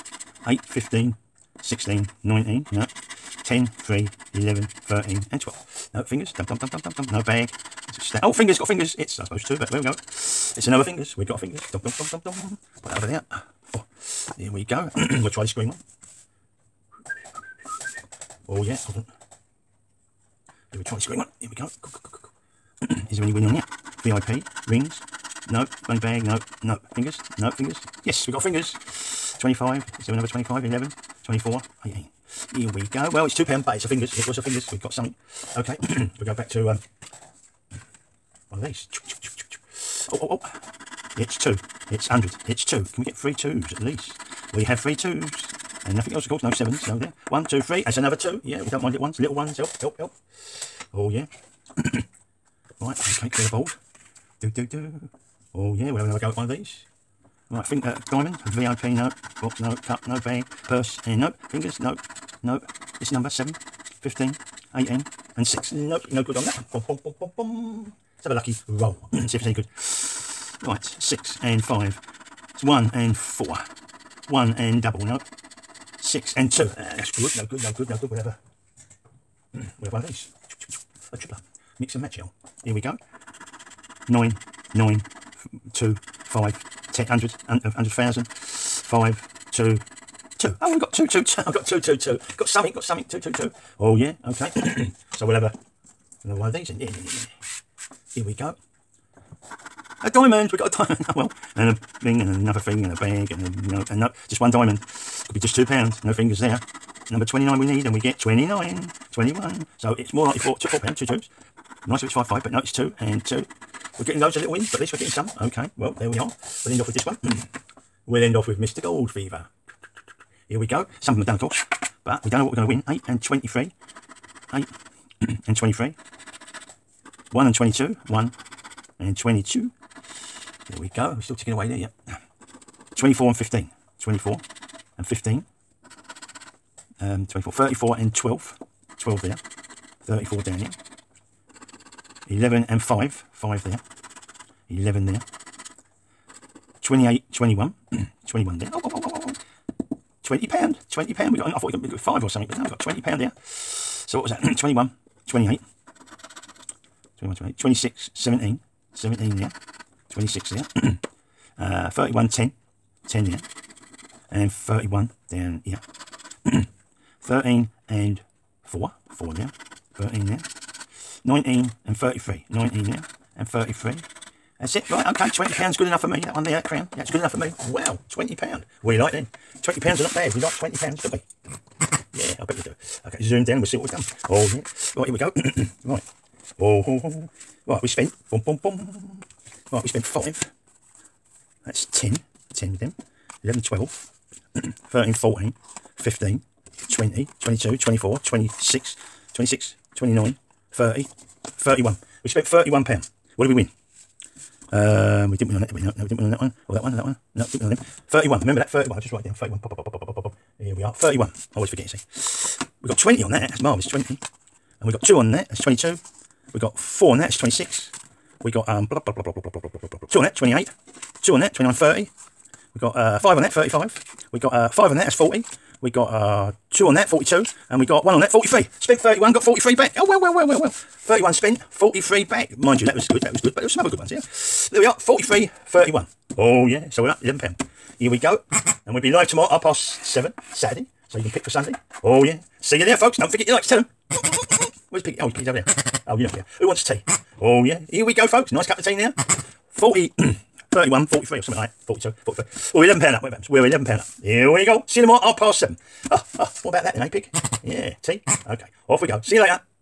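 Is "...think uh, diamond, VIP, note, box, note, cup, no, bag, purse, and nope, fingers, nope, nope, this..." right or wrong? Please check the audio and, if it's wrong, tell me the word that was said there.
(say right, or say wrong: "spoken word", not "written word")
right.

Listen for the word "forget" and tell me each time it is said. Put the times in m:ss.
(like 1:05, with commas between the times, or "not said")
3:31, 4:03.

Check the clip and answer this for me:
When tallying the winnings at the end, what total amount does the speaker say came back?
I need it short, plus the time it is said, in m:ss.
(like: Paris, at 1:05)
43, at 3:48.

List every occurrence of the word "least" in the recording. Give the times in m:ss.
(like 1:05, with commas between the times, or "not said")
0:43, 1:54.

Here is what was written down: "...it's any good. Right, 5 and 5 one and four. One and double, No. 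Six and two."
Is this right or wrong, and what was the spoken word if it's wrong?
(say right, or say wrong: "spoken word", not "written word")
wrong: "6", not "5".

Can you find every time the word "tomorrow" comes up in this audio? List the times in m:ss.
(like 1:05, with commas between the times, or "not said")
3:59, 4:15.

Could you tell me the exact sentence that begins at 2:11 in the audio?
We're still ticking away there, yep.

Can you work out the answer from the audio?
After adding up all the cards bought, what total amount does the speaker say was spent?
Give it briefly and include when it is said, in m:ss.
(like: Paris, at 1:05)
£31, at 3:22.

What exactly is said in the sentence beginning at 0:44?
We have three twos and nothing else, of course.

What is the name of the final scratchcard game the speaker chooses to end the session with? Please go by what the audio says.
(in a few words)
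Gold Fever.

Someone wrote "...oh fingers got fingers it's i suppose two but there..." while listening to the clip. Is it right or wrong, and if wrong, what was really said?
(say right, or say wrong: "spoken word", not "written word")
right.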